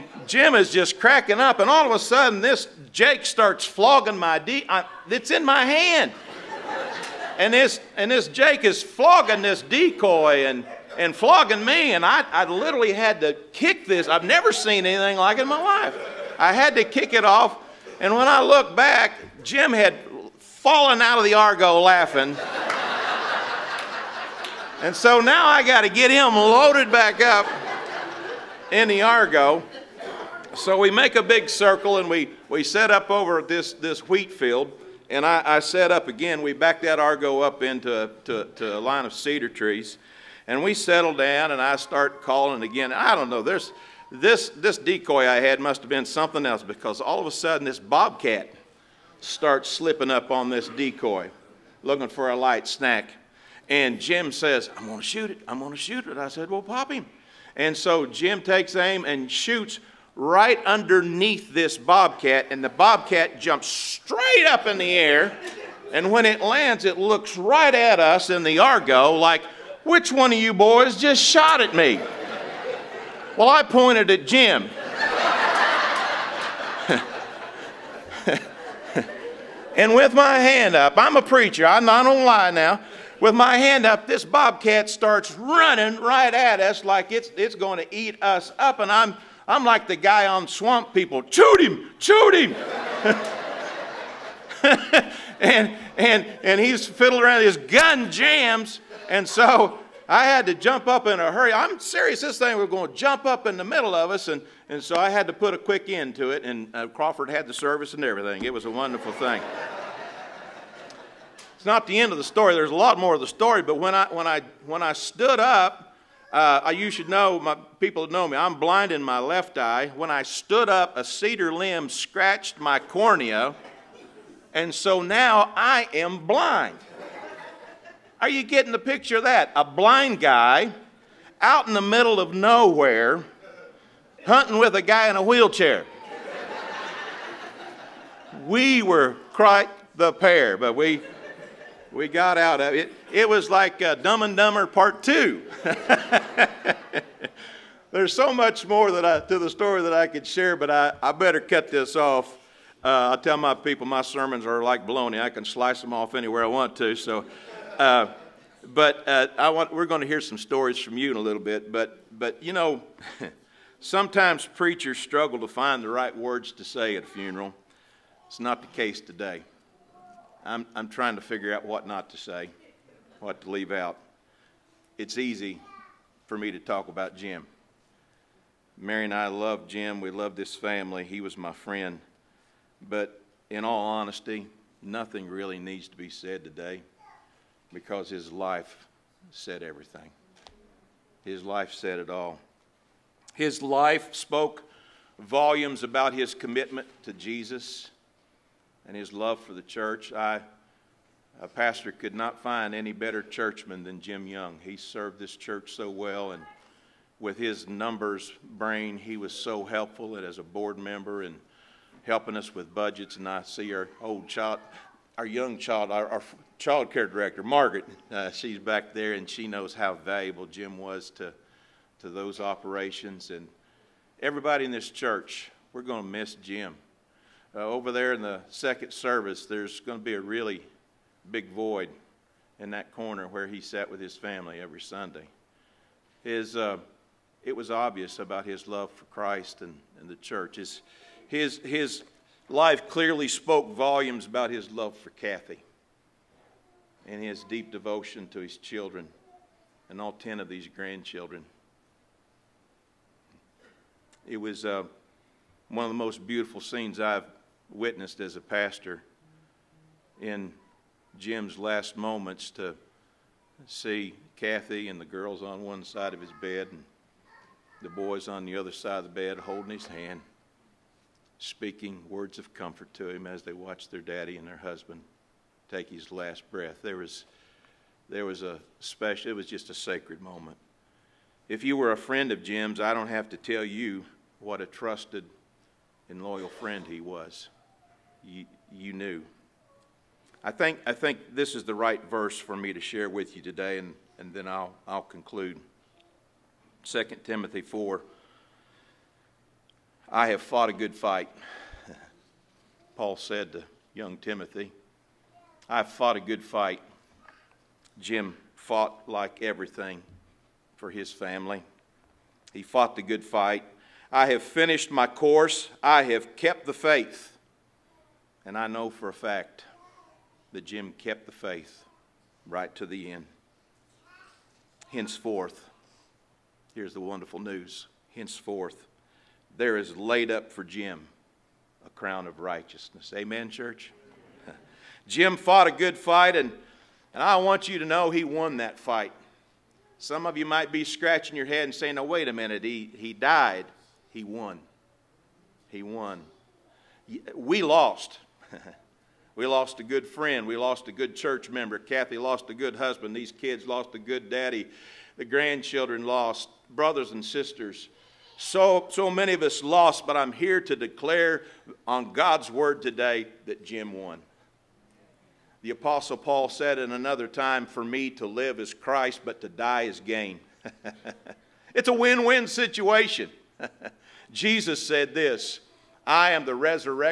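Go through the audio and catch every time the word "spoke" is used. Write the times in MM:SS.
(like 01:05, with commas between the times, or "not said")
03:14, 04:03.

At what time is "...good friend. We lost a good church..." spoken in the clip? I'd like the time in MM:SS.
05:49.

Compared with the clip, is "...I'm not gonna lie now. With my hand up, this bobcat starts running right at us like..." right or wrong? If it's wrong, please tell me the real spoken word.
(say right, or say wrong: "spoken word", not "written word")
right.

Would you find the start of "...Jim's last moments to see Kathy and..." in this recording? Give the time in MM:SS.
04:21.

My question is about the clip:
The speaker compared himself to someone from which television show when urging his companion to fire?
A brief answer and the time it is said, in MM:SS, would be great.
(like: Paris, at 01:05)
Swamp People, at 01:30.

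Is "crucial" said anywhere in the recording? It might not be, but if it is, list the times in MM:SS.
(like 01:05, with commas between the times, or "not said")
not said.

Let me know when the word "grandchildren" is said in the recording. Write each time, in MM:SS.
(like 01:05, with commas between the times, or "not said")
04:10, 05:55.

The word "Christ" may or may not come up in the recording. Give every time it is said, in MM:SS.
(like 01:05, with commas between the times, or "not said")
03:59, 06:08.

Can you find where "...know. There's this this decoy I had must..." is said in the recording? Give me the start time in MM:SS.
00:43.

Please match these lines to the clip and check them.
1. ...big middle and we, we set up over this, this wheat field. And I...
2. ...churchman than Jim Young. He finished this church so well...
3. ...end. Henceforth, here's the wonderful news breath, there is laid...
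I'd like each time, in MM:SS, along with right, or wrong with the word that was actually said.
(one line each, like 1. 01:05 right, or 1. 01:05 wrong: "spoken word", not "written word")
1. 00:31 wrong: "circle", not "middle"
2. 03:23 wrong: "served", not "finished"
3. 05:23 wrong: "henceforth", not "breath".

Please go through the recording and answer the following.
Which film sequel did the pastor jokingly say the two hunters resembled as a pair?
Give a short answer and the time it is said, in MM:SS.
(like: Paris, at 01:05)
Dumb and Dumber Part 2, at 02:23.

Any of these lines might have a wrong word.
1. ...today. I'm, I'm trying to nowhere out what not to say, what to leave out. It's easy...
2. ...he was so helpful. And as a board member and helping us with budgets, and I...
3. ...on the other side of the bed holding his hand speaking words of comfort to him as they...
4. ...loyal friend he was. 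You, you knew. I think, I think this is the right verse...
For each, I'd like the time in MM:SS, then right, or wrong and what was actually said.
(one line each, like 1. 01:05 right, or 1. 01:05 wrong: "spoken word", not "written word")
1. 02:49 wrong: "figure", not "nowhere"
2. 03:28 right
3. 04:28 right
4. 04:46 right.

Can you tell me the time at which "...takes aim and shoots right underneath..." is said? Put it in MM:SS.
00:58.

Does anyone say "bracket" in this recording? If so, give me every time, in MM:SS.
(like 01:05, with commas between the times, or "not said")
not said.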